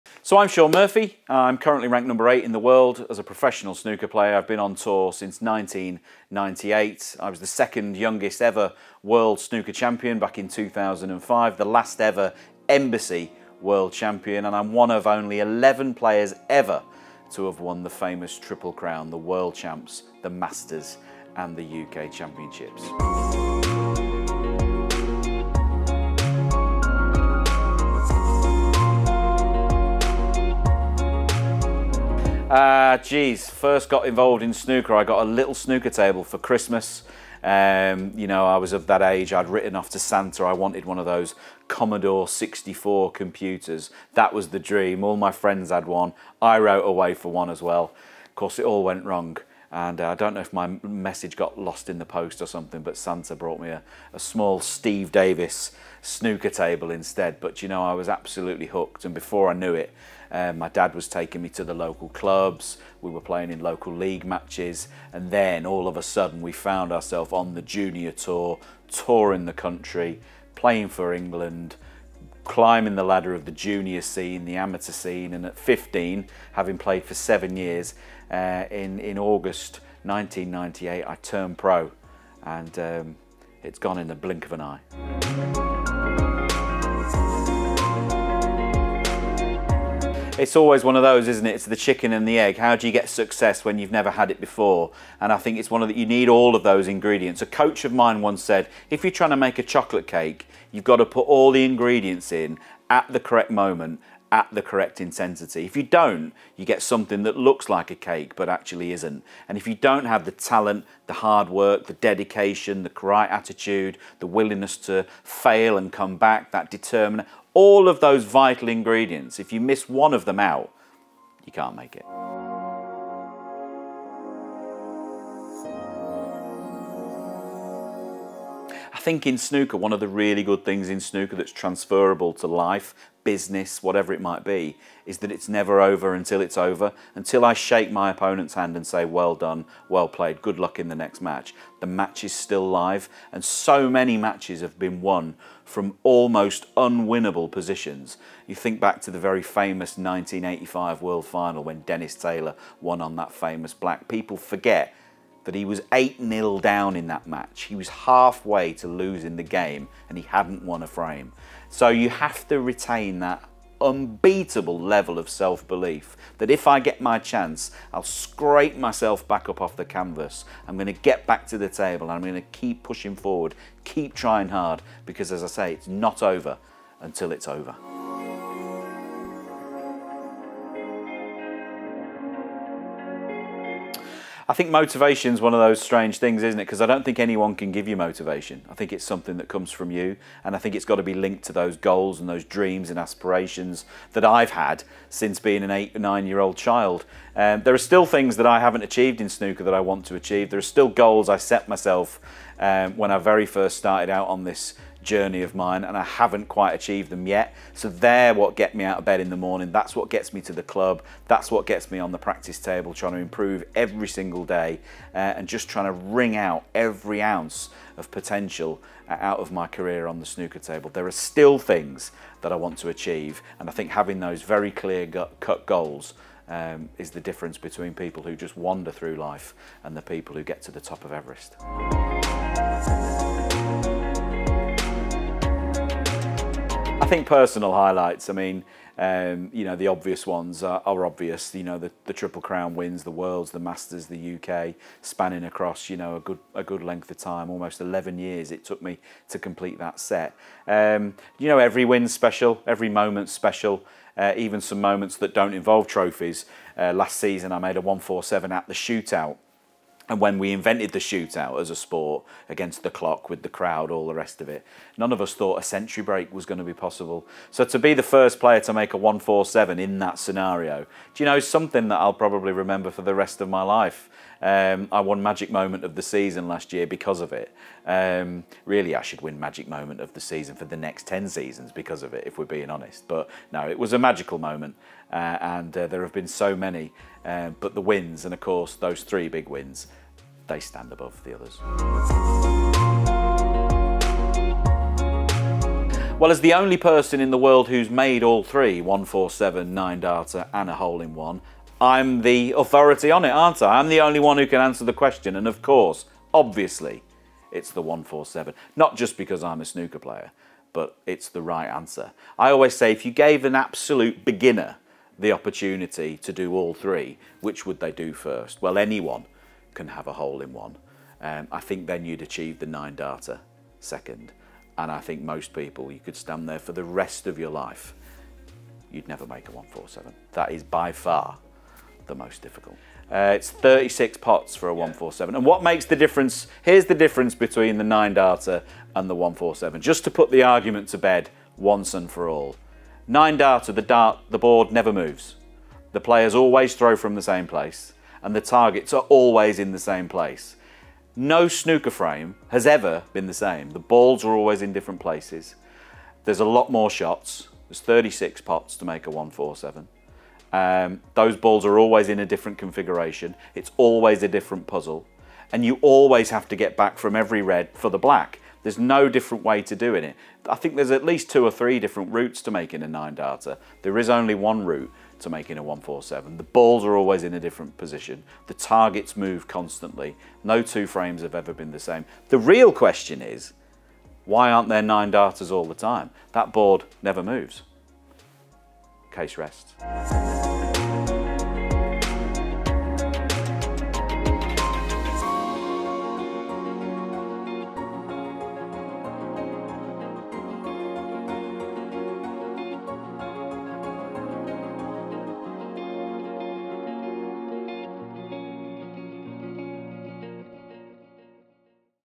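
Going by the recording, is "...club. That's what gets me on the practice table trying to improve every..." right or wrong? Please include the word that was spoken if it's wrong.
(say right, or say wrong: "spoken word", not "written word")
right.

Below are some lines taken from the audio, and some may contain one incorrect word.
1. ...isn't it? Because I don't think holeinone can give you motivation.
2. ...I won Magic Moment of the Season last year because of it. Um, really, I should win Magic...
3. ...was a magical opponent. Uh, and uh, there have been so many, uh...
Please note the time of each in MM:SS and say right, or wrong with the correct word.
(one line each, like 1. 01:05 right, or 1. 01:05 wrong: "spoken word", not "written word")
1. 03:06 wrong: "anyone", not "holeinone"
2. 04:34 right
3. 04:43 wrong: "moment", not "opponent".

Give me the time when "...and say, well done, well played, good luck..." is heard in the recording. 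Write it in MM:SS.
02:18.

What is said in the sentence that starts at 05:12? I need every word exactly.
I always say if you gave an absolute beginner the opportunity to do all three, which would they do first?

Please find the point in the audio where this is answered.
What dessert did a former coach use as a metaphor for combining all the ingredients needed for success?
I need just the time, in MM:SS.
01:39.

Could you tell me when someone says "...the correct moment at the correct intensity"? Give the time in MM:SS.
01:43.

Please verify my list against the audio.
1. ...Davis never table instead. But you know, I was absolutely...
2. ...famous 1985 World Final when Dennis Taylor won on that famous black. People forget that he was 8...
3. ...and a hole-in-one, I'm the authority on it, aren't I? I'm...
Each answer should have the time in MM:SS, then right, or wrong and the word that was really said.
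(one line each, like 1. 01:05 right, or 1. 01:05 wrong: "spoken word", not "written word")
1. 00:55 wrong: "snooker", not "never"
2. 02:29 right
3. 05:00 right.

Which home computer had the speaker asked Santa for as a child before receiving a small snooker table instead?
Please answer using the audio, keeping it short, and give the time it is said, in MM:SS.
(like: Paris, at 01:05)
Commodore 64, at 00:41.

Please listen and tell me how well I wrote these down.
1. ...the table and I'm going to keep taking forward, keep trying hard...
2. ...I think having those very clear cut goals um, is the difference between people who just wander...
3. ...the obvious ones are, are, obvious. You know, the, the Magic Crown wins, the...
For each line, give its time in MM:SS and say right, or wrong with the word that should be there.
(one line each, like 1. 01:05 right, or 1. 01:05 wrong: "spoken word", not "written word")
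1. 02:51 wrong: "pushing", not "taking"
2. 03:43 right
3. 03:59 wrong: "Triple", not "Magic".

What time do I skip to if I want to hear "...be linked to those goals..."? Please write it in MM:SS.
03:11.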